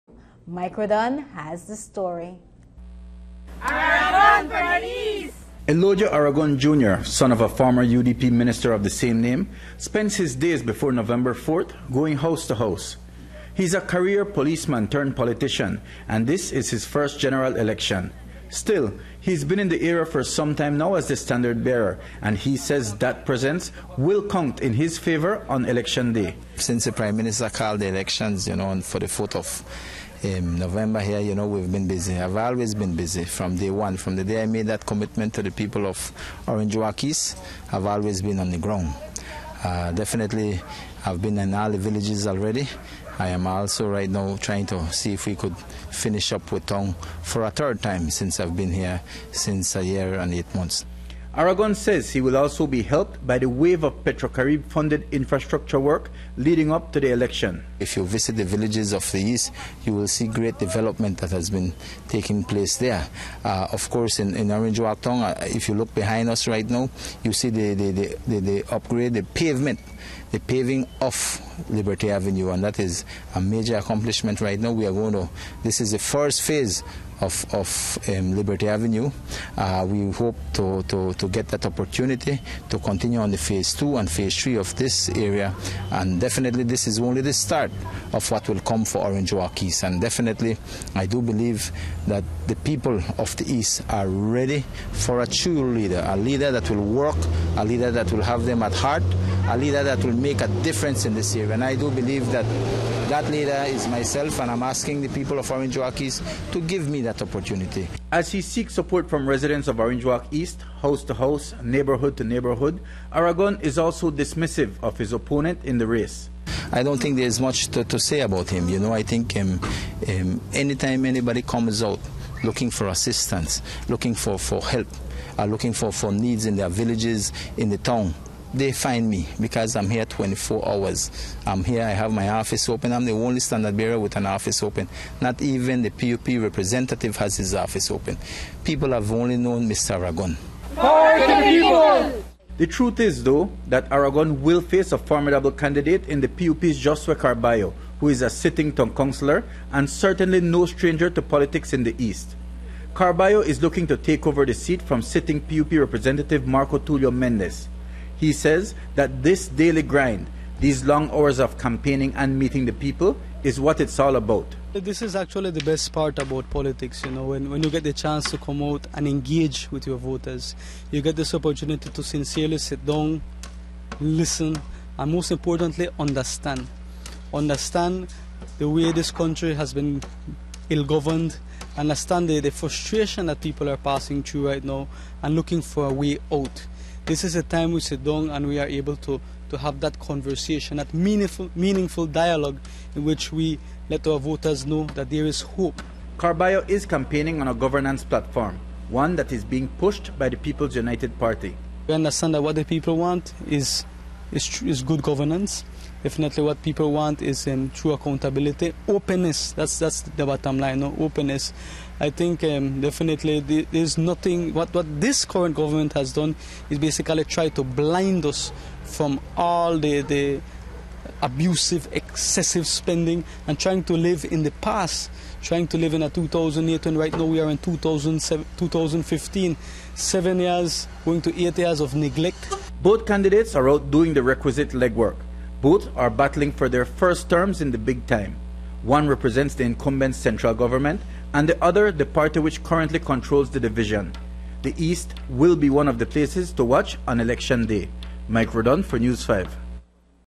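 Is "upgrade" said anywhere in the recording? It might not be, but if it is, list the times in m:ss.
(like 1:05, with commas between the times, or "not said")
1:08.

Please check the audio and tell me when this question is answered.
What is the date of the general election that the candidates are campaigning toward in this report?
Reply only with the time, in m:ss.
0:10.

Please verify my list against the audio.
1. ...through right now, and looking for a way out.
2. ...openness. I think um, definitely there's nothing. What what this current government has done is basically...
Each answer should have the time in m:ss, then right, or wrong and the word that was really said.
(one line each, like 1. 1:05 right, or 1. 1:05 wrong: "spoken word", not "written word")
1. 3:04 right
2. 3:30 right.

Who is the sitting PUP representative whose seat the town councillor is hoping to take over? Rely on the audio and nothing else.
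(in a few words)
Marco Tulio Mendez.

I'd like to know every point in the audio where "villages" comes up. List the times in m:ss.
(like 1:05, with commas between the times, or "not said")
0:41, 0:58, 2:06.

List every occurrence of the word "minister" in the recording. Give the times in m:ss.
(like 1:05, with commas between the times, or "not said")
0:08, 0:27.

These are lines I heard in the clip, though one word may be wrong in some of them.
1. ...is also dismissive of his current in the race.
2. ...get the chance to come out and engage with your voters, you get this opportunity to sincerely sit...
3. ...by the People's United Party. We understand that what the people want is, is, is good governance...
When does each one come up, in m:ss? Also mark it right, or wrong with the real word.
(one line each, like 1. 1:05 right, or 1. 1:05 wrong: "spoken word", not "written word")
1. 1:53 wrong: "opponent", not "current"
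2. 2:47 right
3. 3:20 right.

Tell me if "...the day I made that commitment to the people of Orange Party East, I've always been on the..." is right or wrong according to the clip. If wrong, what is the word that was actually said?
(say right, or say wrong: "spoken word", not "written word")
wrong: "Walk", not "Party".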